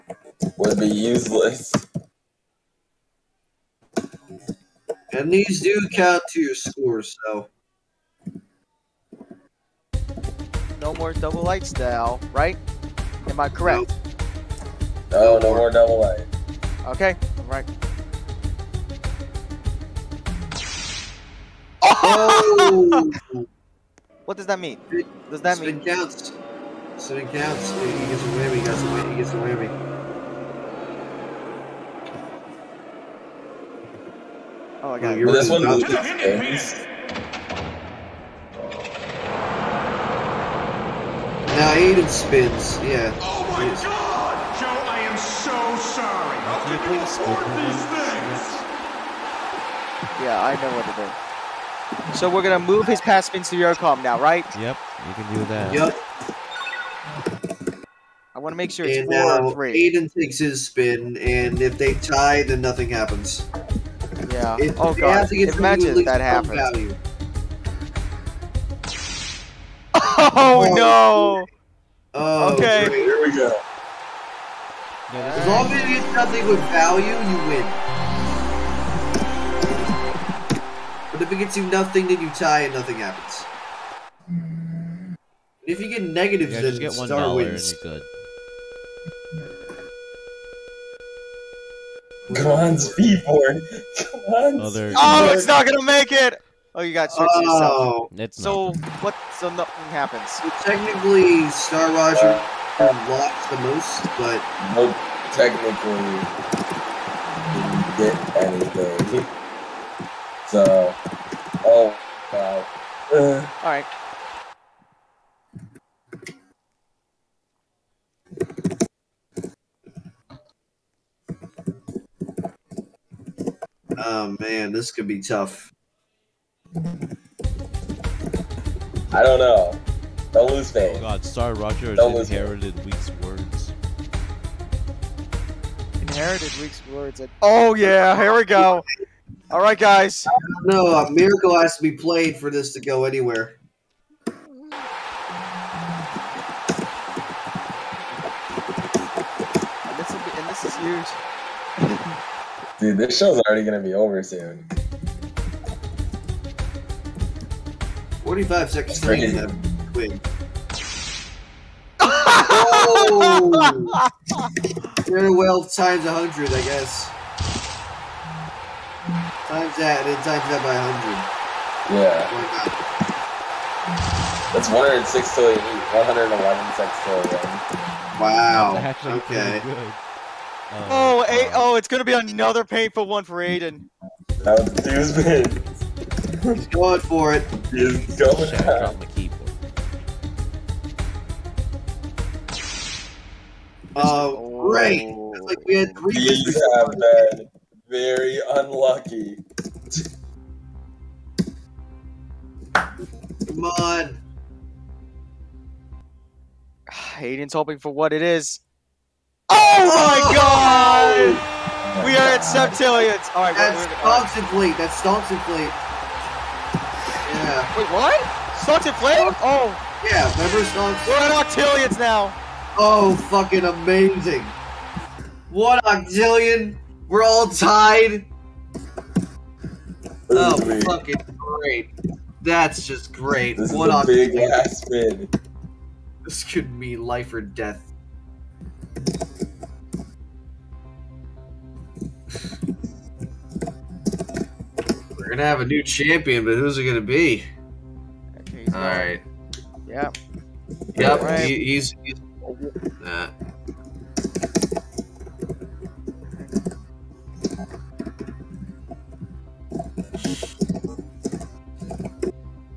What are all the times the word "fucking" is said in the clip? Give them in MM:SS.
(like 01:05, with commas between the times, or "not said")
03:43, 03:50.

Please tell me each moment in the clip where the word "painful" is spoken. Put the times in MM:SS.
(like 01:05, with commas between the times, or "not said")
03:02.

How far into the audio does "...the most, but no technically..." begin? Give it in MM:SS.
01:43.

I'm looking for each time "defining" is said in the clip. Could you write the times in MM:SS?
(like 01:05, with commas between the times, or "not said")
not said.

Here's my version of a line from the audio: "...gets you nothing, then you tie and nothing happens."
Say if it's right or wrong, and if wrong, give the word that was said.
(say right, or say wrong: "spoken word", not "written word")
right.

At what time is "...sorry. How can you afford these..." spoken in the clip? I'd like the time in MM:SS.
00:45.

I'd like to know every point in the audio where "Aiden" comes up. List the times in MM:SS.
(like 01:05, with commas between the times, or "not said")
00:41, 00:59, 03:03.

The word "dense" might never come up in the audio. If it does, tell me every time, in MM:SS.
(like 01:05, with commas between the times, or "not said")
not said.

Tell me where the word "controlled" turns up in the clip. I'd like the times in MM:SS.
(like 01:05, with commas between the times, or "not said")
not said.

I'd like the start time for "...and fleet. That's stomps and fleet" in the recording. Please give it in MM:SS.
03:34.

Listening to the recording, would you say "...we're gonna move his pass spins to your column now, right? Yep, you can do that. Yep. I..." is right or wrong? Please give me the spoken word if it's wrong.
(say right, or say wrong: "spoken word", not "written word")
right.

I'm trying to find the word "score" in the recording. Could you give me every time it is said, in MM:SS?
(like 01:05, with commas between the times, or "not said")
00:06.